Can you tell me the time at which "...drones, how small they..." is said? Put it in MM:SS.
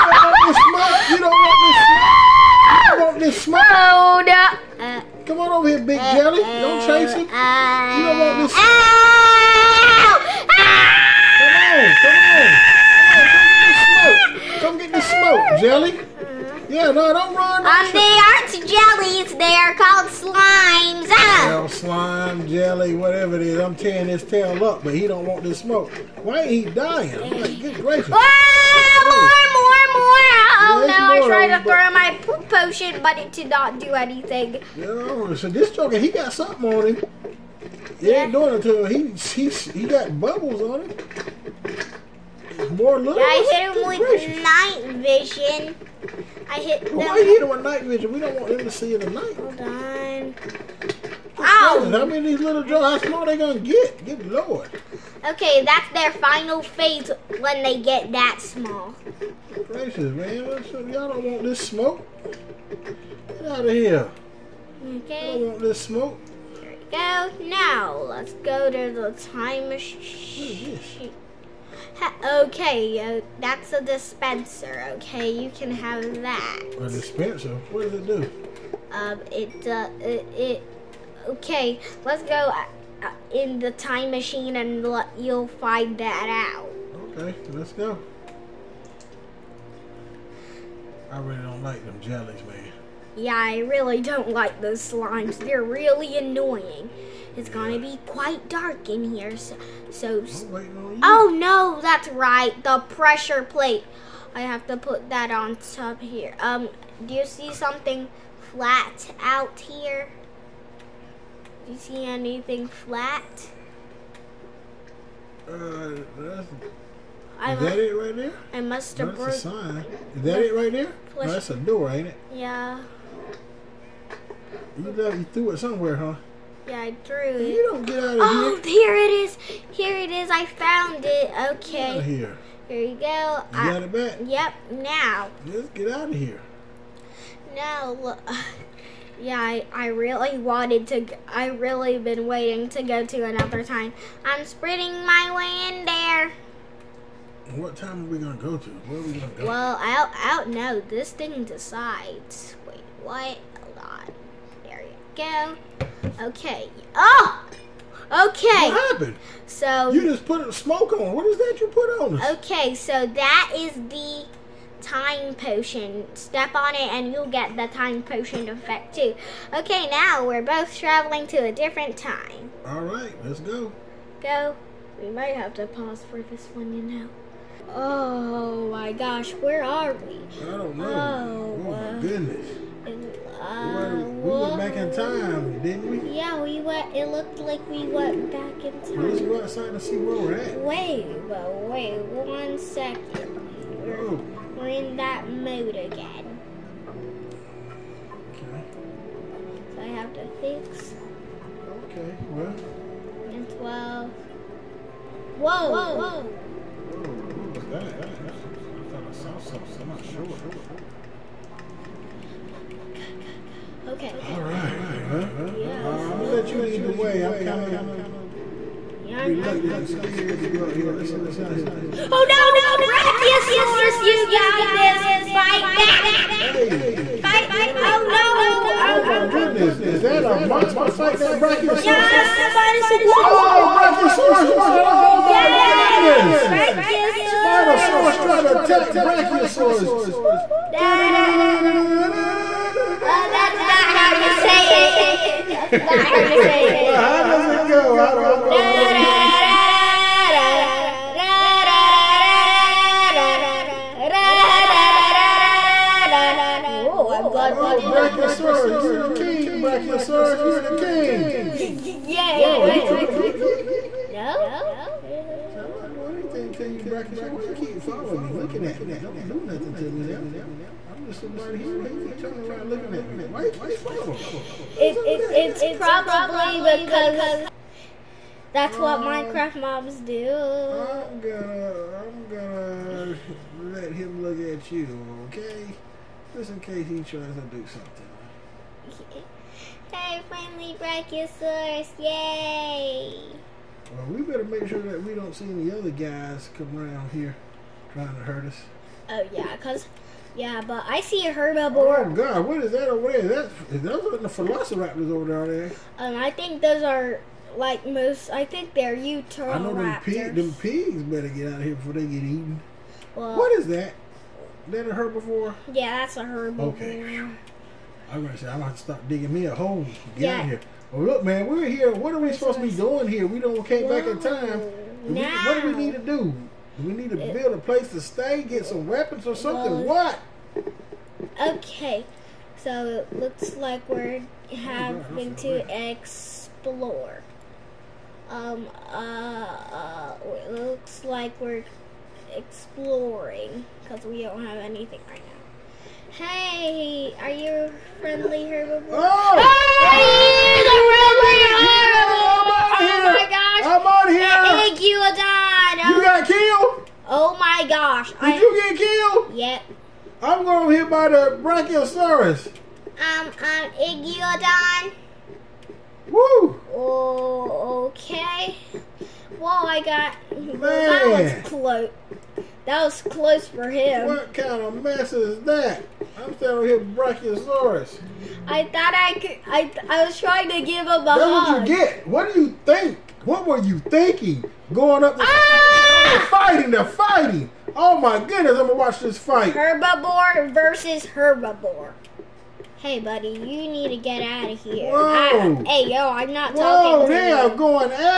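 00:52.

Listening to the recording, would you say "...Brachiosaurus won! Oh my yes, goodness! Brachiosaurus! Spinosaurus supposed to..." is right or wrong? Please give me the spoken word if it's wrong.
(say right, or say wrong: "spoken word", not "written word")
wrong: "tried", not "supposed".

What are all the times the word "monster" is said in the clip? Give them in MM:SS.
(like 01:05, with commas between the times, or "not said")
03:50.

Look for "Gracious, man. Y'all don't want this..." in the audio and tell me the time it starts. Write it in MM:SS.
00:59.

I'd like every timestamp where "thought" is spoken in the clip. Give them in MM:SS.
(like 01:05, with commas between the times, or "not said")
03:28, 06:18.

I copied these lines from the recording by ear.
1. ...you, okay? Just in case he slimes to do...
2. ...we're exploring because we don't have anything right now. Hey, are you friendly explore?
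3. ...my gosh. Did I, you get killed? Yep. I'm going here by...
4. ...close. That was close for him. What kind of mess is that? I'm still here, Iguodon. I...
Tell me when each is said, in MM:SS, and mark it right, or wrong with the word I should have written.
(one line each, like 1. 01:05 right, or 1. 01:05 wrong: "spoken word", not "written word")
1. 04:44 wrong: "tries", not "slimes"
2. 05:41 wrong: "herbivore", not "explore"
3. 05:57 right
4. 06:11 wrong: "Brachiosaurus", not "Iguodon".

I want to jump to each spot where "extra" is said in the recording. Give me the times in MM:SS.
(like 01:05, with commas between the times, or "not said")
not said.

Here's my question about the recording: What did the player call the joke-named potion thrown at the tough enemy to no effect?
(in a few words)
poop potion.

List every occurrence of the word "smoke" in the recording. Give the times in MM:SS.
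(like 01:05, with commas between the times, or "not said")
00:25, 01:01, 01:05, 02:40.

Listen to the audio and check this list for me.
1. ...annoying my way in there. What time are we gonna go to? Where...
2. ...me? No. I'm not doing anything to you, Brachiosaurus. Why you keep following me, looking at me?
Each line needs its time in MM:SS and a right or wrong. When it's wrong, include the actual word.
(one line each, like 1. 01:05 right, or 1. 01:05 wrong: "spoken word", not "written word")
1. 02:24 wrong: "sprinting", not "annoying"
2. 04:23 right.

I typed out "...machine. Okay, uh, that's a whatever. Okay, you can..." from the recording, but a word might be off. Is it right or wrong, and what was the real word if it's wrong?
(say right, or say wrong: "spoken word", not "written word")
wrong: "dispenser", not "whatever".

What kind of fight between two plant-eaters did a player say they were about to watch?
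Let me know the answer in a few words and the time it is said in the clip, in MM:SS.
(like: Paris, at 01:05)
Herbivore versus herbivore, at 06:29.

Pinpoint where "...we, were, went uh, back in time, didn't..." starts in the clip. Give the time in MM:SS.
03:03.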